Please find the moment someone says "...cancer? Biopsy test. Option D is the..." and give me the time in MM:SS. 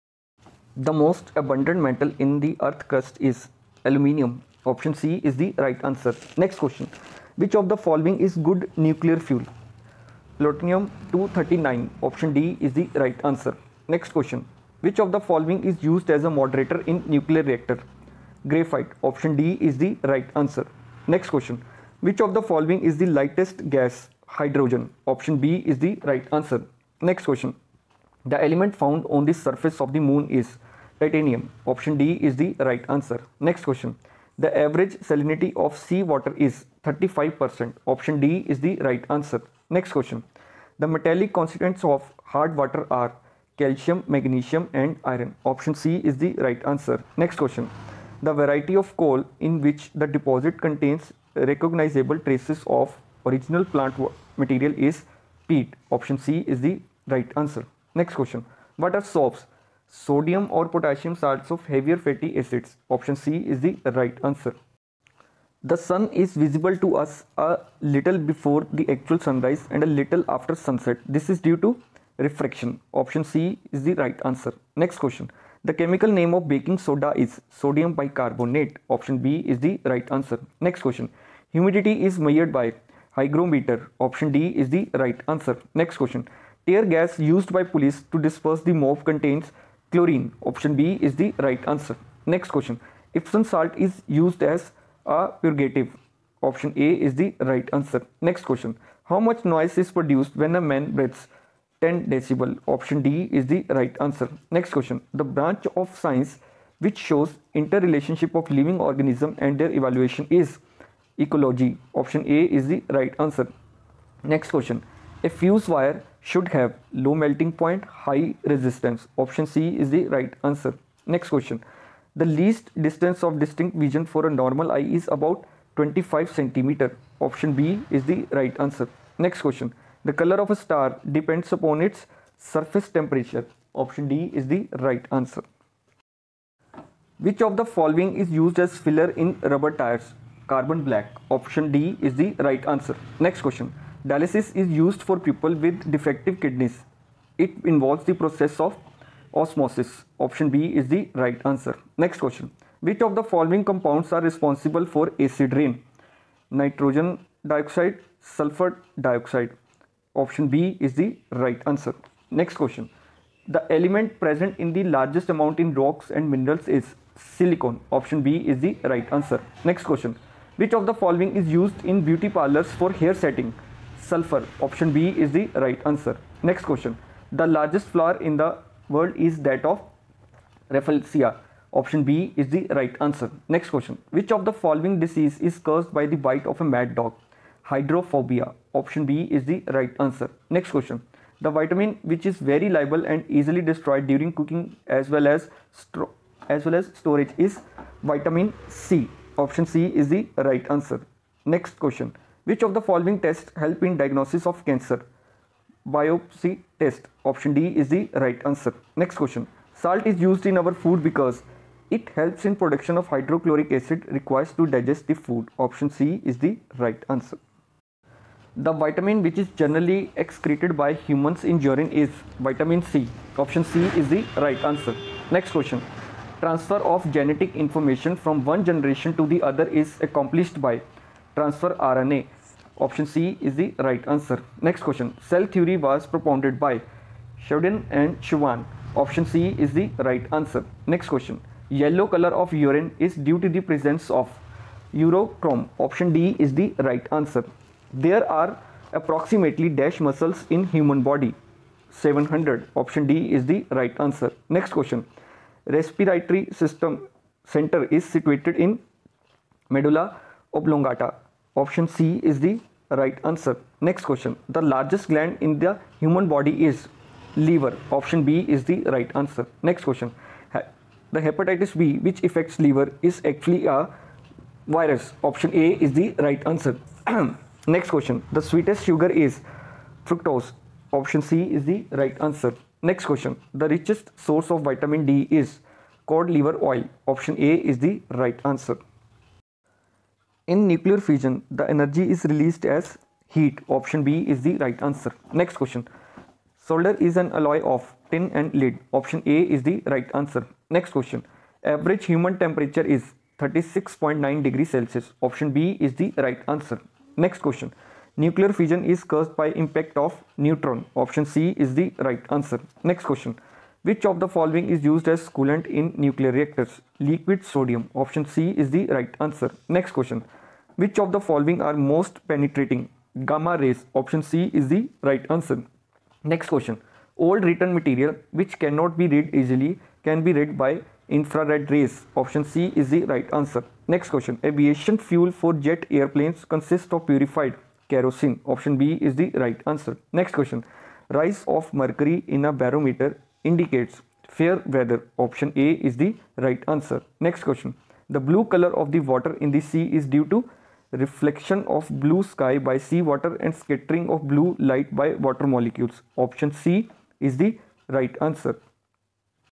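03:24.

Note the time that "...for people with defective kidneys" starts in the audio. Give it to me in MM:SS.
02:25.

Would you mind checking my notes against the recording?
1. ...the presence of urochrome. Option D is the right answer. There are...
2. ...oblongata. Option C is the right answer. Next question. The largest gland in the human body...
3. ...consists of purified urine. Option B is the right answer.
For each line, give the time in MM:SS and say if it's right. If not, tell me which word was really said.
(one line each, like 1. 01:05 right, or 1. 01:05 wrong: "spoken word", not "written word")
1. 04:03 right
2. 04:20 right
3. 05:36 wrong: "kerosene", not "urine".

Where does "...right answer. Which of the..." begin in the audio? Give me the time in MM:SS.
02:14.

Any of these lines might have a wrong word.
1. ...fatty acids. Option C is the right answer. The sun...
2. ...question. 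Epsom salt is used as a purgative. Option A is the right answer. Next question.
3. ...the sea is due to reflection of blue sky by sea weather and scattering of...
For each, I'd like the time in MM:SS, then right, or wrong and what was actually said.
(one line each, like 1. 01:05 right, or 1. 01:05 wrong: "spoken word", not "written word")
1. 01:01 right
2. 01:32 right
3. 05:49 wrong: "water", not "weather".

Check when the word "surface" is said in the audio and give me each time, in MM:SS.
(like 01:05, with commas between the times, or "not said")
00:29, 02:12.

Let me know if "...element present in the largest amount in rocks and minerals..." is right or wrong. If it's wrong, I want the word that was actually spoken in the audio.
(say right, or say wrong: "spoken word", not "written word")
right.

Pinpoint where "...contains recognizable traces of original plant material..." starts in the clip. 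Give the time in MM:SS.
00:50.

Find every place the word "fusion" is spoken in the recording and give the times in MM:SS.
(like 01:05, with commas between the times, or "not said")
04:50, 05:08.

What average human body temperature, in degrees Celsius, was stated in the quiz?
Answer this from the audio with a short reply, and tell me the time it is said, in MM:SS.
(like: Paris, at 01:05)
36.9, at 05:03.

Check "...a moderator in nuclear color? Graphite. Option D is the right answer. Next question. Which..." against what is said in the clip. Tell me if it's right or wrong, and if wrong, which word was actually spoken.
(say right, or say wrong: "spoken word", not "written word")
wrong: "reactor", not "color".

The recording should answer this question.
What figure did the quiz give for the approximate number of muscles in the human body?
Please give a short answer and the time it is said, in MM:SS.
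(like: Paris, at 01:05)
700, at 04:11.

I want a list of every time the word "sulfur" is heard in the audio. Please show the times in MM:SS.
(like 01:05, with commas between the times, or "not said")
02:38, 02:54.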